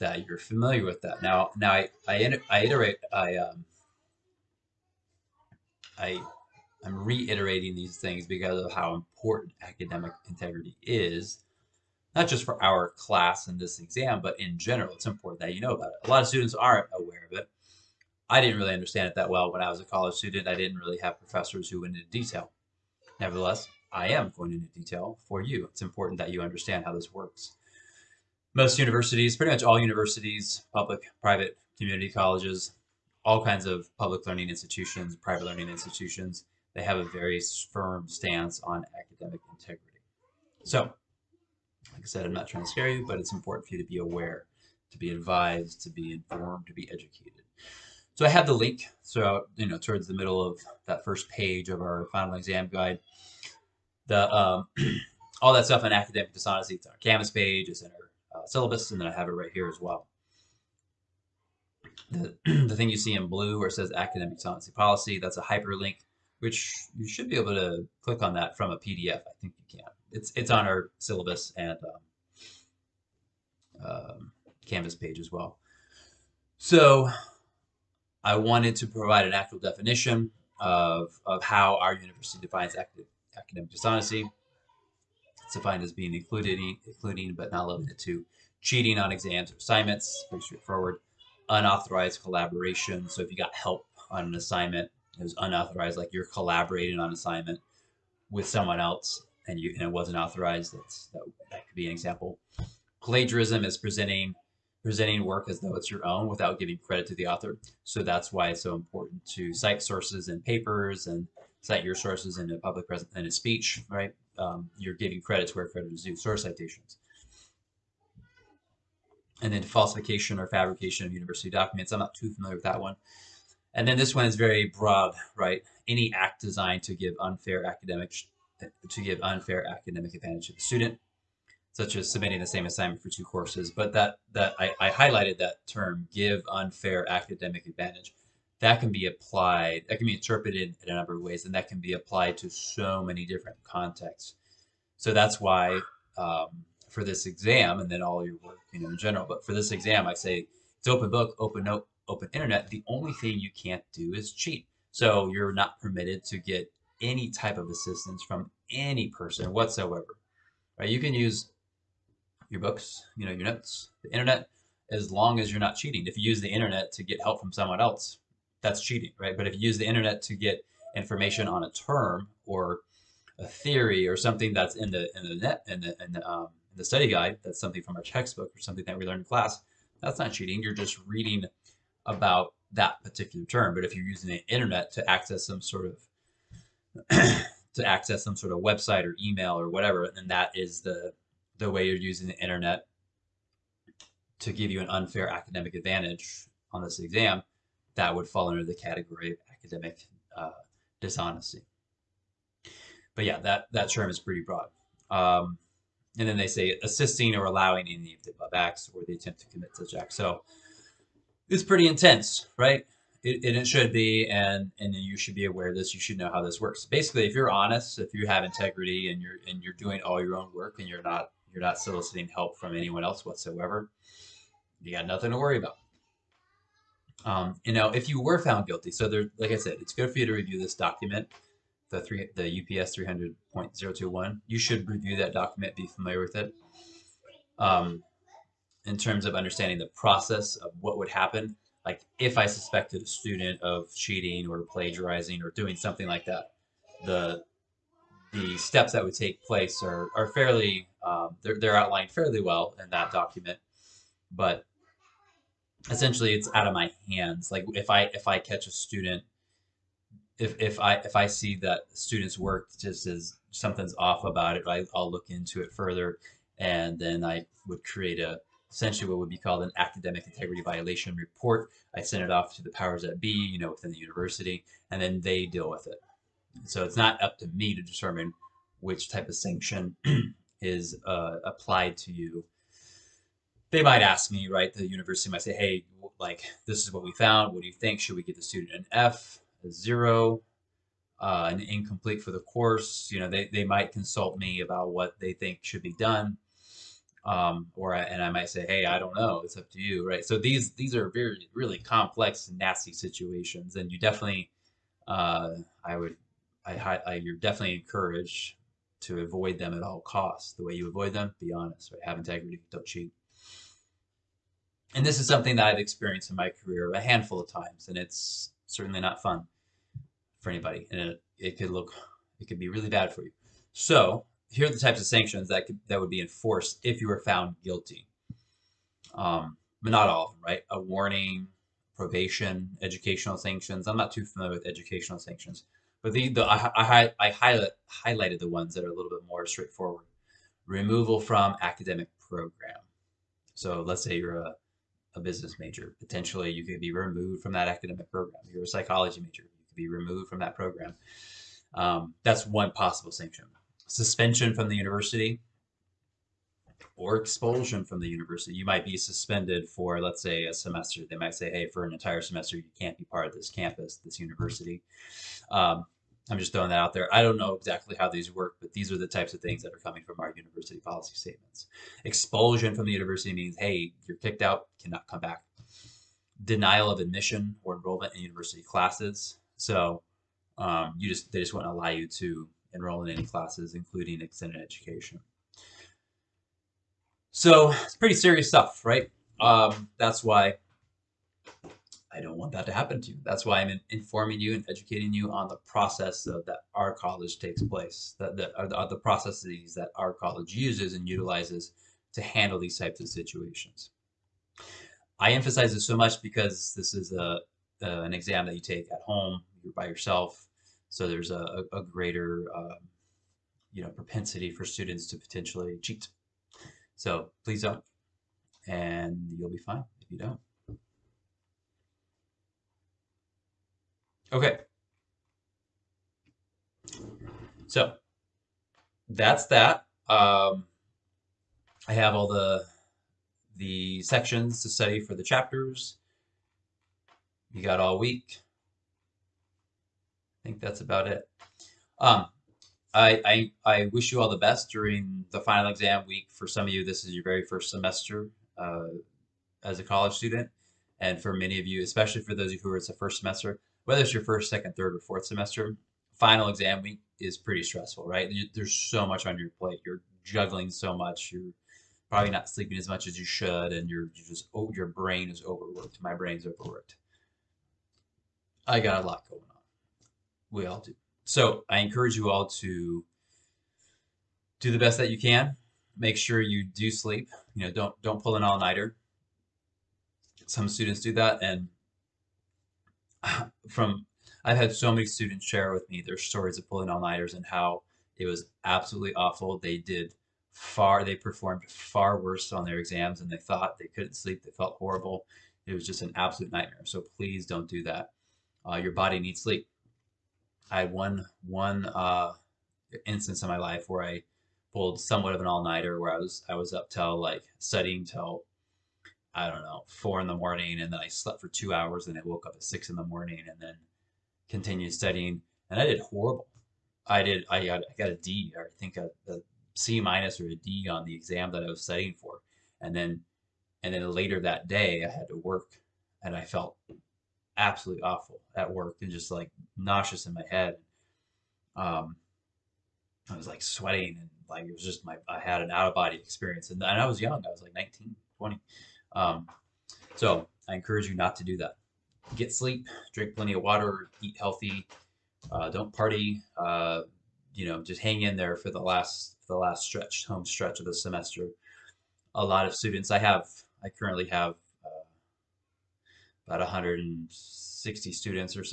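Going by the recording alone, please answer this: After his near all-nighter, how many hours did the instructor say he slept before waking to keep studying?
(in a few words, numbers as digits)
2.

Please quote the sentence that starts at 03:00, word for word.
You're just reading about that particular term.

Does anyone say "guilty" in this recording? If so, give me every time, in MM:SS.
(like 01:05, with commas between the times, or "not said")
03:48, 05:27.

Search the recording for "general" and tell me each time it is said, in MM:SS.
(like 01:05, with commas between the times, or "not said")
00:14, 02:28.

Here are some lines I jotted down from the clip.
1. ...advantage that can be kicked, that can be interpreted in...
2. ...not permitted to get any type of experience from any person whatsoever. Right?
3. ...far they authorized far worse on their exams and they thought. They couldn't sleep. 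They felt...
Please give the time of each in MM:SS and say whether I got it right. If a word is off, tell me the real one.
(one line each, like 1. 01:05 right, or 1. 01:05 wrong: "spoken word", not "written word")
1. 02:17 wrong: "applied", not "kicked"
2. 02:35 wrong: "assistance", not "experience"
3. 08:10 wrong: "performed", not "authorized".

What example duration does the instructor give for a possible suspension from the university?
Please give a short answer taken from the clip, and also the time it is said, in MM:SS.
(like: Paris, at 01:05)
a semester, at 06:00.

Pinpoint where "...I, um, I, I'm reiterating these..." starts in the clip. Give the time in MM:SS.
00:03.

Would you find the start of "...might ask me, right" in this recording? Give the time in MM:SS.
04:43.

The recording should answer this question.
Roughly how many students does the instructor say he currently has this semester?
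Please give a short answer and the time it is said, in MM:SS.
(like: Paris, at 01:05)
160, at 09:16.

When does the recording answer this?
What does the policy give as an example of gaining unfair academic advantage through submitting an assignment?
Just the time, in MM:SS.
02:12.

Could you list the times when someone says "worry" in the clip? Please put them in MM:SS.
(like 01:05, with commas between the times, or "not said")
03:45.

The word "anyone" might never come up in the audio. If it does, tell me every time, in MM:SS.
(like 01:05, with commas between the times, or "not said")
03:42.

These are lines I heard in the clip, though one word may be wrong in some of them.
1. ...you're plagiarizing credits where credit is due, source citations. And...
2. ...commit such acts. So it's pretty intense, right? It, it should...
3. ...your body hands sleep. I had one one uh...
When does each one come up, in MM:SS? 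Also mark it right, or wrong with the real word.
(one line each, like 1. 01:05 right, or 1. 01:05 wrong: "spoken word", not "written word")
1. 01:54 wrong: "giving", not "plagiarizing"
2. 03:29 right
3. 08:18 wrong: "needs", not "hands".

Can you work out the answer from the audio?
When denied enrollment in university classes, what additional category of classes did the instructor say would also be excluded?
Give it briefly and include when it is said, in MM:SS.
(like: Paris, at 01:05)
extended education, at 06:24.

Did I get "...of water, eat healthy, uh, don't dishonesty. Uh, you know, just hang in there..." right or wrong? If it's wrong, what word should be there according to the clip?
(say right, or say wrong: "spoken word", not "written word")
wrong: "party", not "dishonesty".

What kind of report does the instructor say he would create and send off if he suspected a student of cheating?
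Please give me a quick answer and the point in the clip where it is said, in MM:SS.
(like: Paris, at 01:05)
academic integrity violation report, at 04:29.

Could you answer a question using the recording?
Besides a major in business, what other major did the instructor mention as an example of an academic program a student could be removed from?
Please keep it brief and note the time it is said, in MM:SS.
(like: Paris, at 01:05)
psychology, at 05:48.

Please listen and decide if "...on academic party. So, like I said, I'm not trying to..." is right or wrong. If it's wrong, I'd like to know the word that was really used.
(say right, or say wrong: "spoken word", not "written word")
wrong: "integrity", not "party".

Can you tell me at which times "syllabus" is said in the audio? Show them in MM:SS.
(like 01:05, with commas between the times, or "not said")
00:58, 01:10.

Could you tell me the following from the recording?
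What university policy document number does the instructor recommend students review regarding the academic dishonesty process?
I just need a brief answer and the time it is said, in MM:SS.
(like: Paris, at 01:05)
UPS 300.021, at 03:52.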